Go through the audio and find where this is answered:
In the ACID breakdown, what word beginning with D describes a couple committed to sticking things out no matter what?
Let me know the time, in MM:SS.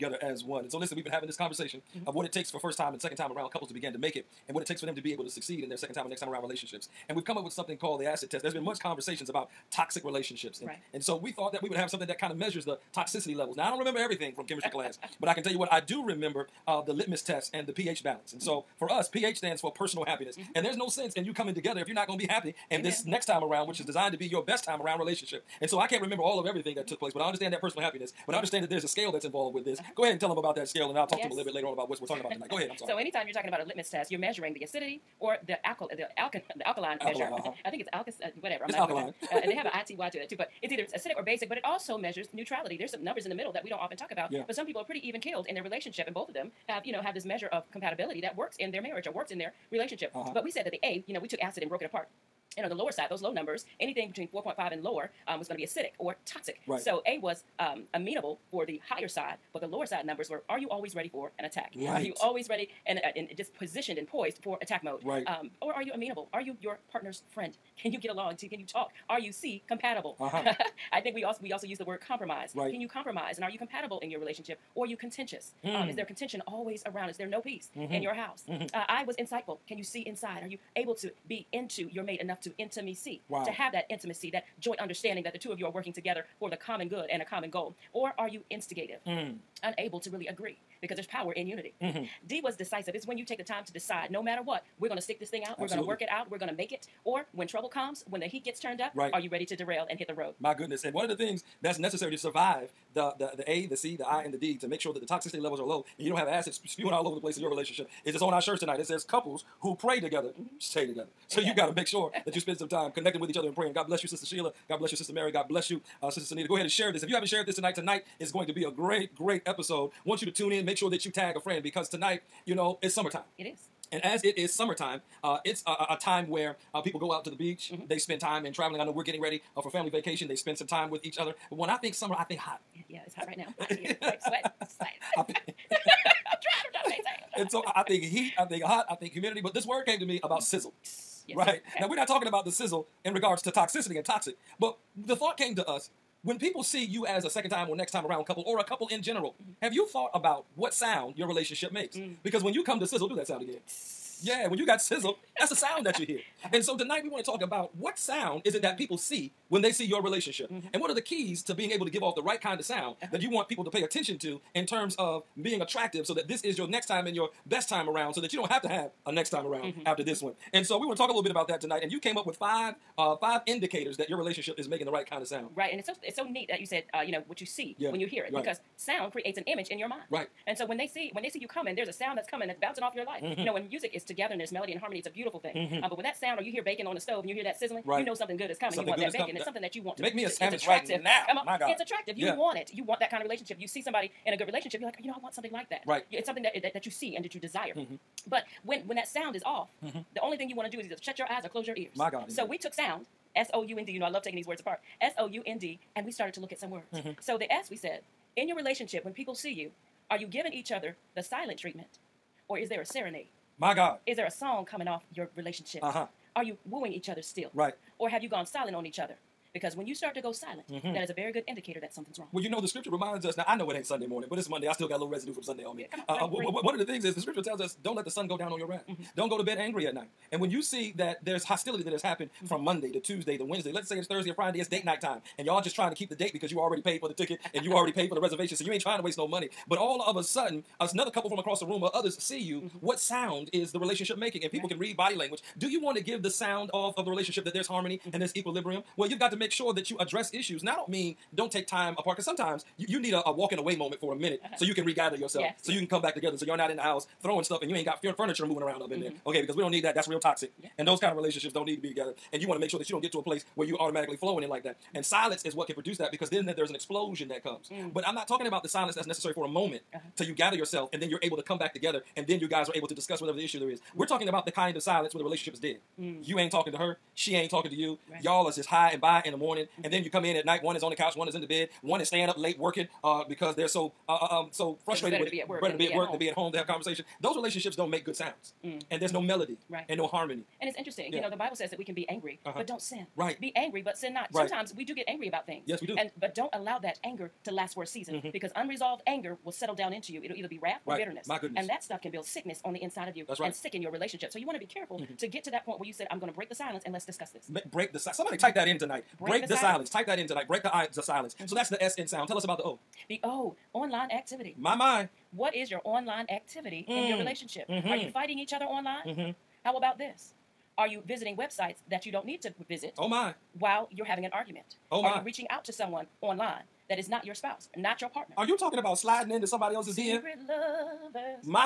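01:32.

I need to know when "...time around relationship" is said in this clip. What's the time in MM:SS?
00:24.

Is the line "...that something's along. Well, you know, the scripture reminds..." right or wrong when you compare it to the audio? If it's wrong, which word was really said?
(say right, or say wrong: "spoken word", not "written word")
wrong: "wrong", not "along".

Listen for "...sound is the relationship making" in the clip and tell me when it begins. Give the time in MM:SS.
04:02.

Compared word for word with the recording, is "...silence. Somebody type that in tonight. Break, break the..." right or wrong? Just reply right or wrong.
right.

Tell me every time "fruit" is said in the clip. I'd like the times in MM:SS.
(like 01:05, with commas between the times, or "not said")
not said.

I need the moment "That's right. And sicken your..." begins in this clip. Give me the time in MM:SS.
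05:03.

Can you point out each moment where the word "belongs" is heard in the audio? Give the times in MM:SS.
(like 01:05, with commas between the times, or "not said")
not said.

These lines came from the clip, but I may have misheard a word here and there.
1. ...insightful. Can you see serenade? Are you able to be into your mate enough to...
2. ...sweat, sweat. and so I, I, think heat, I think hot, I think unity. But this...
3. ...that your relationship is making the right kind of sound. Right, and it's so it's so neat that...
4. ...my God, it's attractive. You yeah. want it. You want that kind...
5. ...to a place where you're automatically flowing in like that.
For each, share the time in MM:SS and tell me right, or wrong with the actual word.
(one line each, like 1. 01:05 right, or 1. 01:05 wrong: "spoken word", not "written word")
1. 01:19 wrong: "inside", not "serenade"
2. 02:14 wrong: "humidity", not "unity"
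3. 02:53 right
4. 03:11 right
5. 04:23 right.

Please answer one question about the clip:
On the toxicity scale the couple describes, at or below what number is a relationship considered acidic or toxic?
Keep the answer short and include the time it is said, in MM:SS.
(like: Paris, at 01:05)
4.5, at 00:54.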